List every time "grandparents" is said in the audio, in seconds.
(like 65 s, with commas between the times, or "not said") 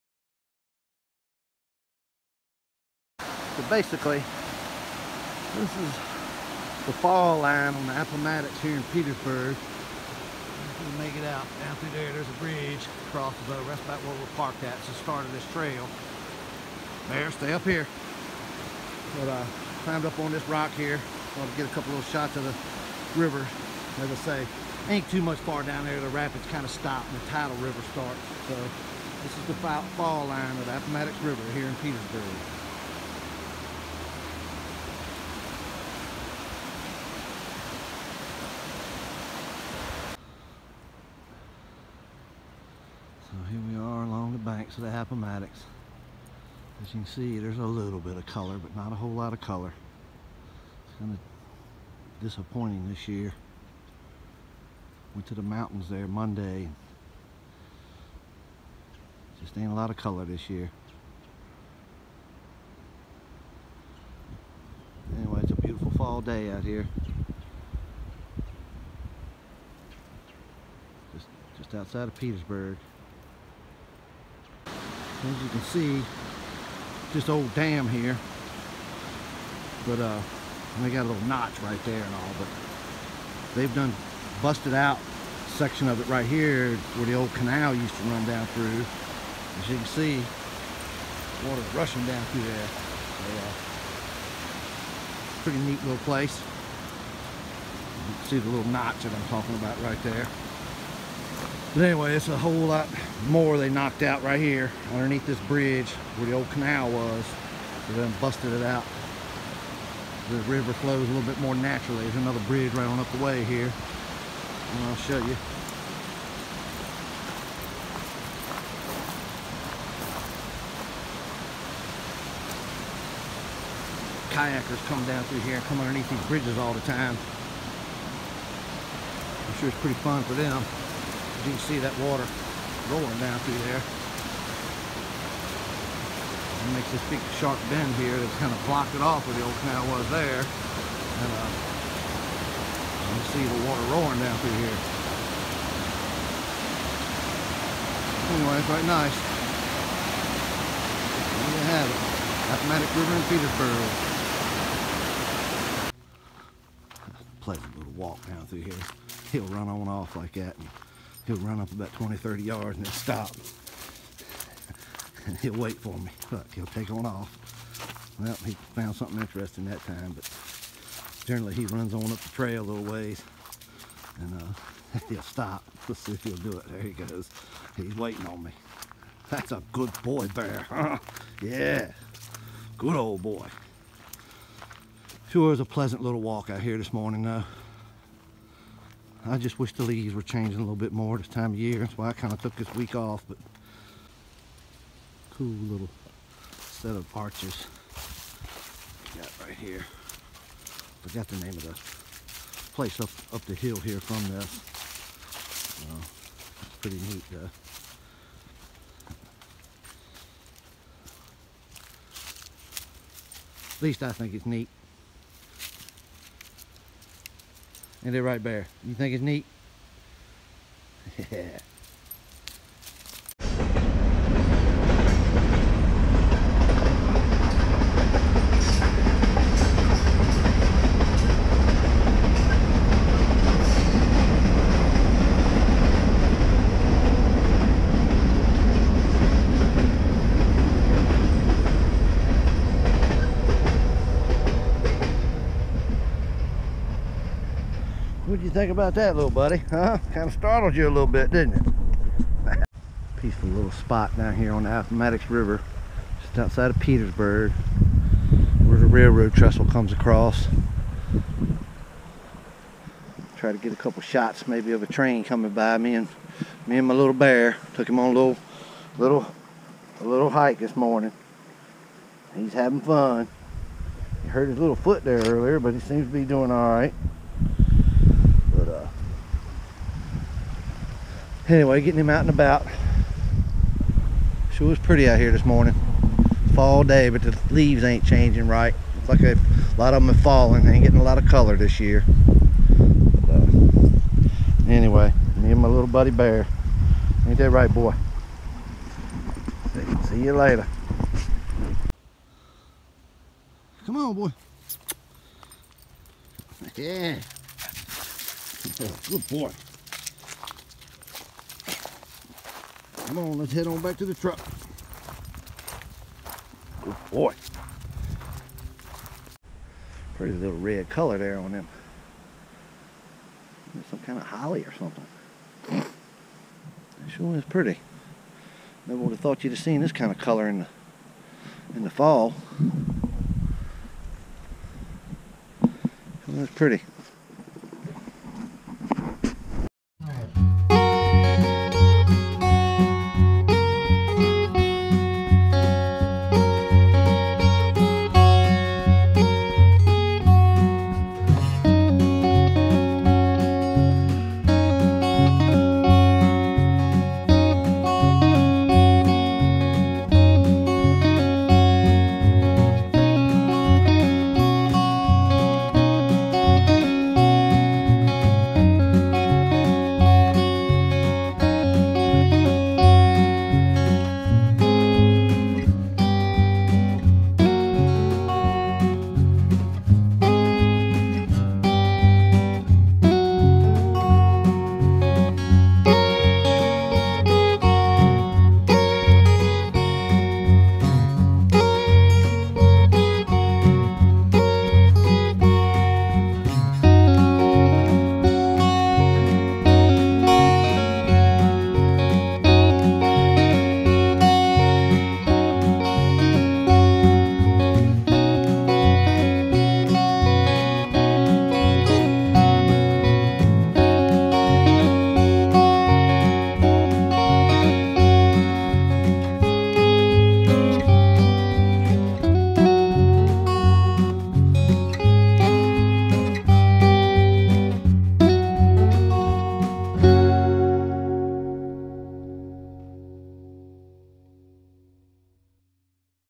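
not said.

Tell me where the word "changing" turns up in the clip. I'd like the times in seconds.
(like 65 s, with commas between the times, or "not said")
190 s, 288 s.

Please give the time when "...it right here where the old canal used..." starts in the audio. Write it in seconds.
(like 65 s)
85 s.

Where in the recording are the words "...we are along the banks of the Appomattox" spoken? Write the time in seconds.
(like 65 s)
43 s.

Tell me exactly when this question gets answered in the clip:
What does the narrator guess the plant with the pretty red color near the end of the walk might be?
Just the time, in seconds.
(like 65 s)
324 s.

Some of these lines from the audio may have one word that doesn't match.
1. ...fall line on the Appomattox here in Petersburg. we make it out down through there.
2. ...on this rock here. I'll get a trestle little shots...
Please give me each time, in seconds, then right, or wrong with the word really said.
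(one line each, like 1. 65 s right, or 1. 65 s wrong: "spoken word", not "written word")
1. 6 s right
2. 20 s wrong: "couple", not "trestle".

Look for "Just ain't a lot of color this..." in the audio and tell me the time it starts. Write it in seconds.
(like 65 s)
59 s.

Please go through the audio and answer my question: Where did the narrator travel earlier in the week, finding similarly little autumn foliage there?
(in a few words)
the mountains.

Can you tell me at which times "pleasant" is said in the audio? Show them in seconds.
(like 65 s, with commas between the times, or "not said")
157 s, 185 s.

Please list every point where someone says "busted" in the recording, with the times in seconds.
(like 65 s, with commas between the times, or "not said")
84 s, 108 s.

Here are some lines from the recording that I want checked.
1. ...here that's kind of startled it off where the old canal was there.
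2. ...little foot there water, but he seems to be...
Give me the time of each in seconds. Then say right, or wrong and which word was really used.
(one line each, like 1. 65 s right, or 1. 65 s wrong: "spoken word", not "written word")
1. 137 s wrong: "blocked", not "startled"
2. 274 s wrong: "earlier", not "water".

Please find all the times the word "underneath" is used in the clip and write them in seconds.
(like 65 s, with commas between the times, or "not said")
104 s, 125 s.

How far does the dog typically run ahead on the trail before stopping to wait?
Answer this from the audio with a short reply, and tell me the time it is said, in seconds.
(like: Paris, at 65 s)
20 to 30 yards, at 161 s.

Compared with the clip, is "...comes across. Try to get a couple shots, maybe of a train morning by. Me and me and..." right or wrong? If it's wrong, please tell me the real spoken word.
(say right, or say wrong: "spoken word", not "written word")
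wrong: "coming", not "morning".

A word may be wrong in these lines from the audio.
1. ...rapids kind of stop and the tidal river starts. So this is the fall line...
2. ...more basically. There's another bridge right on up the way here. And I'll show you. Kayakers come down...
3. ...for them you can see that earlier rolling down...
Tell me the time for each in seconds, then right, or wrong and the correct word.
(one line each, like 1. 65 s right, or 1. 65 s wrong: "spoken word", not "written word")
1. 26 s right
2. 111 s wrong: "naturally", not "basically"
3. 130 s wrong: "water", not "earlier".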